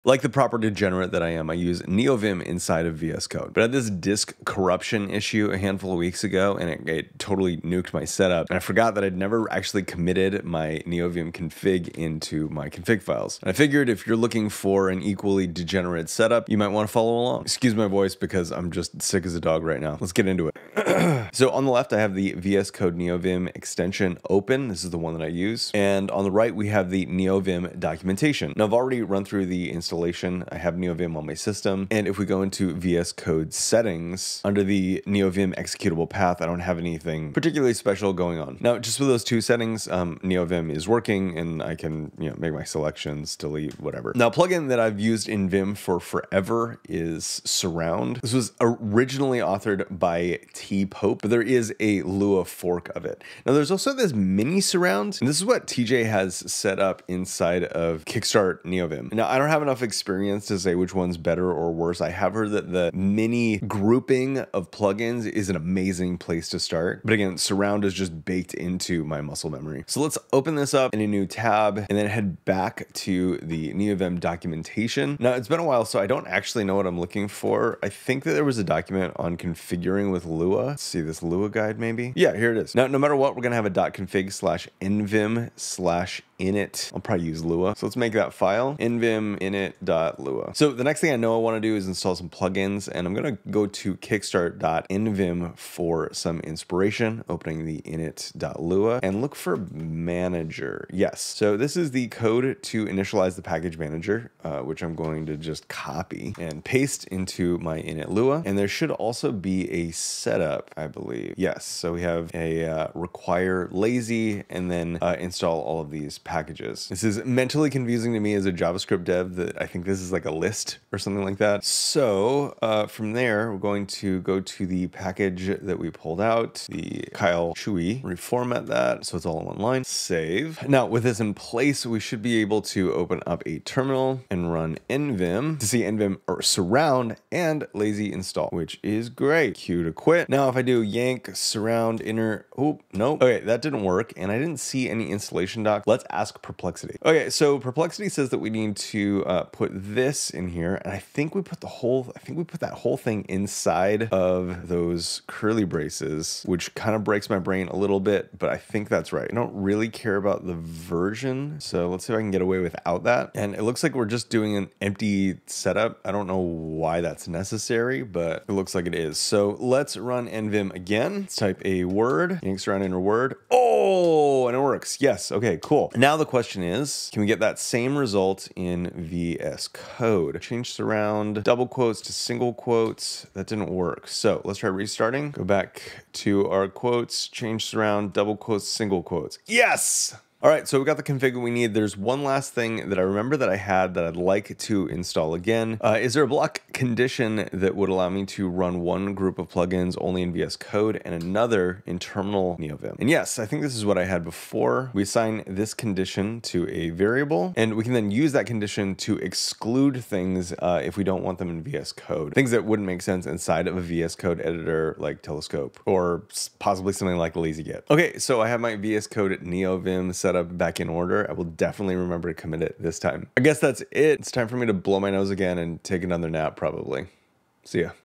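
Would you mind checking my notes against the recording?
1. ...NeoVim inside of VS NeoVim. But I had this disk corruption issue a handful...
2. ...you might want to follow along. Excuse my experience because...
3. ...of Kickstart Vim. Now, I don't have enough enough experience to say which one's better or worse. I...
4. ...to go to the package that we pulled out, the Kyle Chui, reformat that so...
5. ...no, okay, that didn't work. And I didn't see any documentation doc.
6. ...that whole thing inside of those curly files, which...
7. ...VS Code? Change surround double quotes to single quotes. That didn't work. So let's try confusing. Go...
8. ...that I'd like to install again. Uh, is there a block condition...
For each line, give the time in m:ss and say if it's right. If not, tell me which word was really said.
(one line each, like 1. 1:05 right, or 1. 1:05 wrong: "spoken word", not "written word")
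1. 0:01 wrong: "Code", not "NeoVim"
2. 0:16 wrong: "voice", not "experience"
3. 0:57 wrong: "NeoVim", not "Vim"
4. 2:04 right
5. 2:22 wrong: "installation", not "documentation"
6. 2:32 wrong: "braces", not "files"
7. 2:58 wrong: "restarting", not "confusing"
8. 3:13 right.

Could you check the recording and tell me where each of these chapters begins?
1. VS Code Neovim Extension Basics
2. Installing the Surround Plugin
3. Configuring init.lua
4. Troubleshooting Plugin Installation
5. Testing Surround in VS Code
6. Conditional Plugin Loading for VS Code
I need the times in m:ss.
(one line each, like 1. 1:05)
1. 0:20
2. 0:44
3. 1:22
4. 2:19
5. 2:55
6. 3:15.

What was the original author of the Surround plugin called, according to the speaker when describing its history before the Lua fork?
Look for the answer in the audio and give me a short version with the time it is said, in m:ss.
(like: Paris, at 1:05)
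T. Pope, at 0:50.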